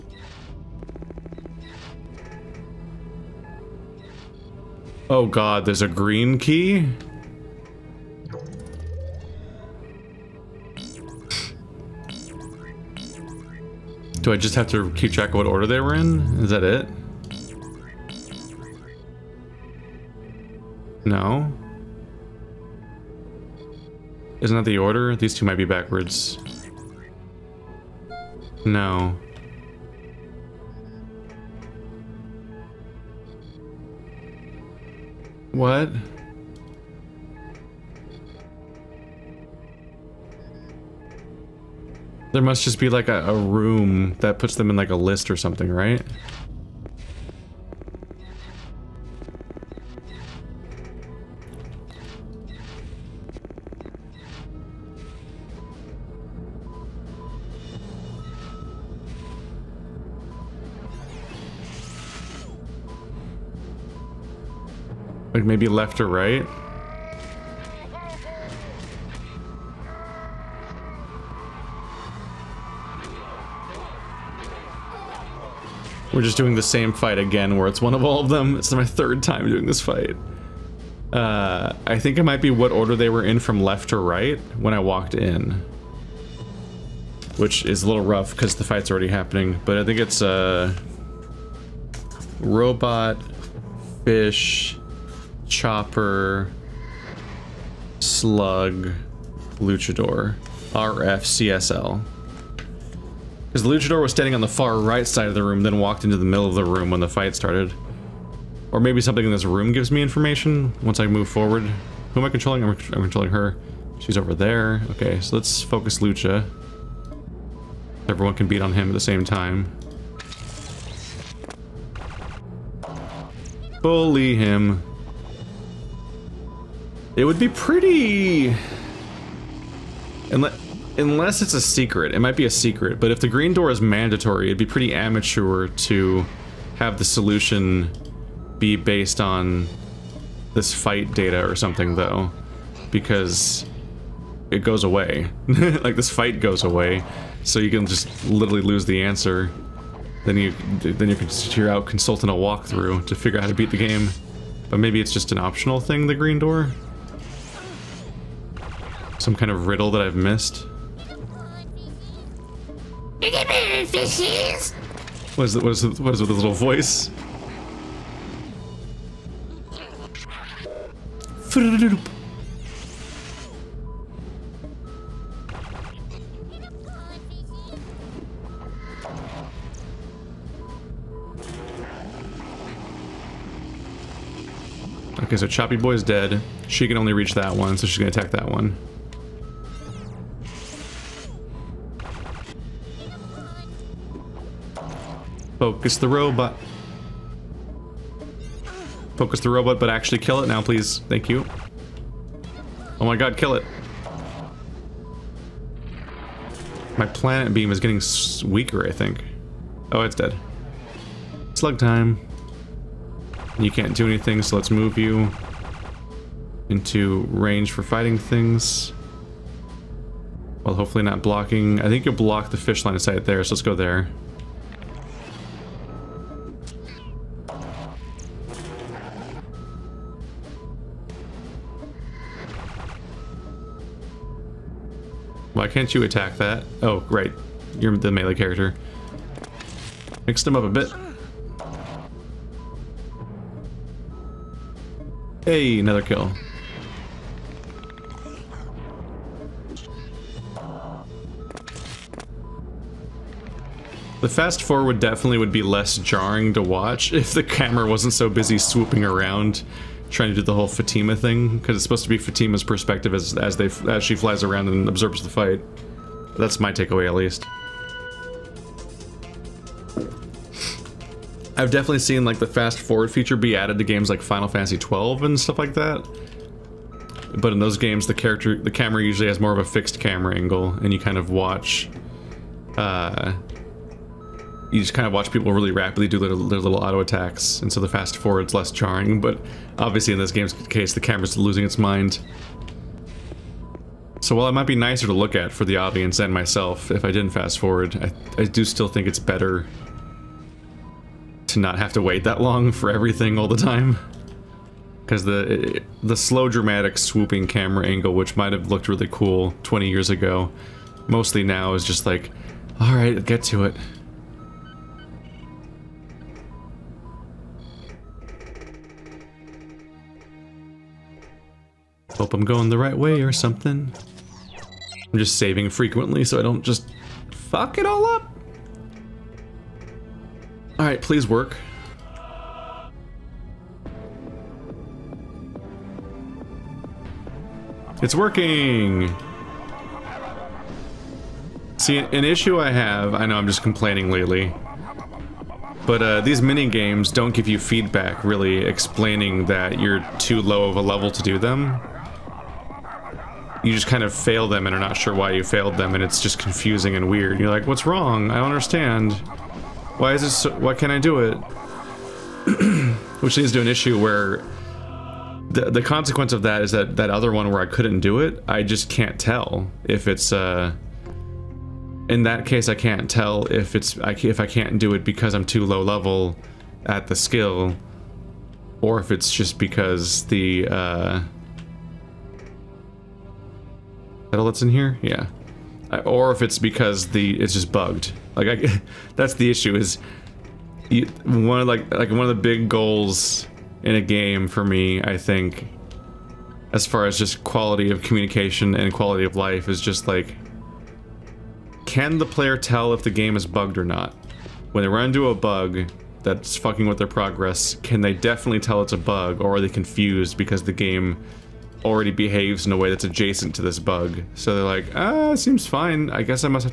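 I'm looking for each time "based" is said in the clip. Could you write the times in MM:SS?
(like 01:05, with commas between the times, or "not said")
02:18.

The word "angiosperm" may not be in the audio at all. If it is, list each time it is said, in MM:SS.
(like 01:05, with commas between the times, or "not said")
not said.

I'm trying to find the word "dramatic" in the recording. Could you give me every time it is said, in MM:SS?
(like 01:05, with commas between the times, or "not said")
05:06.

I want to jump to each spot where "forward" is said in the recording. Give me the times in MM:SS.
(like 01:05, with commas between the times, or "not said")
01:51, 04:14, 04:32, 04:48, 04:57.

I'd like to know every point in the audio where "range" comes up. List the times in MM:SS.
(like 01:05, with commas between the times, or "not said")
03:37.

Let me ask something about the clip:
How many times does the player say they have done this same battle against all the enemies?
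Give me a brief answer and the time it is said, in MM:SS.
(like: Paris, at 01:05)
3, at 01:18.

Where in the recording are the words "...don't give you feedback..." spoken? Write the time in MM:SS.
05:47.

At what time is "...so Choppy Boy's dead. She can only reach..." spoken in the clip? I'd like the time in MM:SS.
03:05.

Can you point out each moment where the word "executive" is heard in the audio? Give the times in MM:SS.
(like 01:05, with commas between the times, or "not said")
not said.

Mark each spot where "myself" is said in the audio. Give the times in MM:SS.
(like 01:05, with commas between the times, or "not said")
04:56.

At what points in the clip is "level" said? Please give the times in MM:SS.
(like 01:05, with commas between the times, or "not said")
05:50, 06:15.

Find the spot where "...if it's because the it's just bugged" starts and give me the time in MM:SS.
06:26.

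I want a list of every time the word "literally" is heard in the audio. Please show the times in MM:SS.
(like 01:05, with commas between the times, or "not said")
02:28.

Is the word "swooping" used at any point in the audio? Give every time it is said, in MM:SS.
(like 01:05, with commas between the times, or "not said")
04:18, 05:06.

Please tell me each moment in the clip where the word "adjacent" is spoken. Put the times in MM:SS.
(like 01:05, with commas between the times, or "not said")
06:53.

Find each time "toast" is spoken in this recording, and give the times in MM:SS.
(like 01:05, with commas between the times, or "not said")
not said.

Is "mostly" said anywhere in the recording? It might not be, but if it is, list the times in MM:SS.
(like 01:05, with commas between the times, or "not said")
05:11.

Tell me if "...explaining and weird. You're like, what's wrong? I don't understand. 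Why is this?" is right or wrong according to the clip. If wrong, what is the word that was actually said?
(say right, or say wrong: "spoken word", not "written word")
wrong: "confusing", not "explaining".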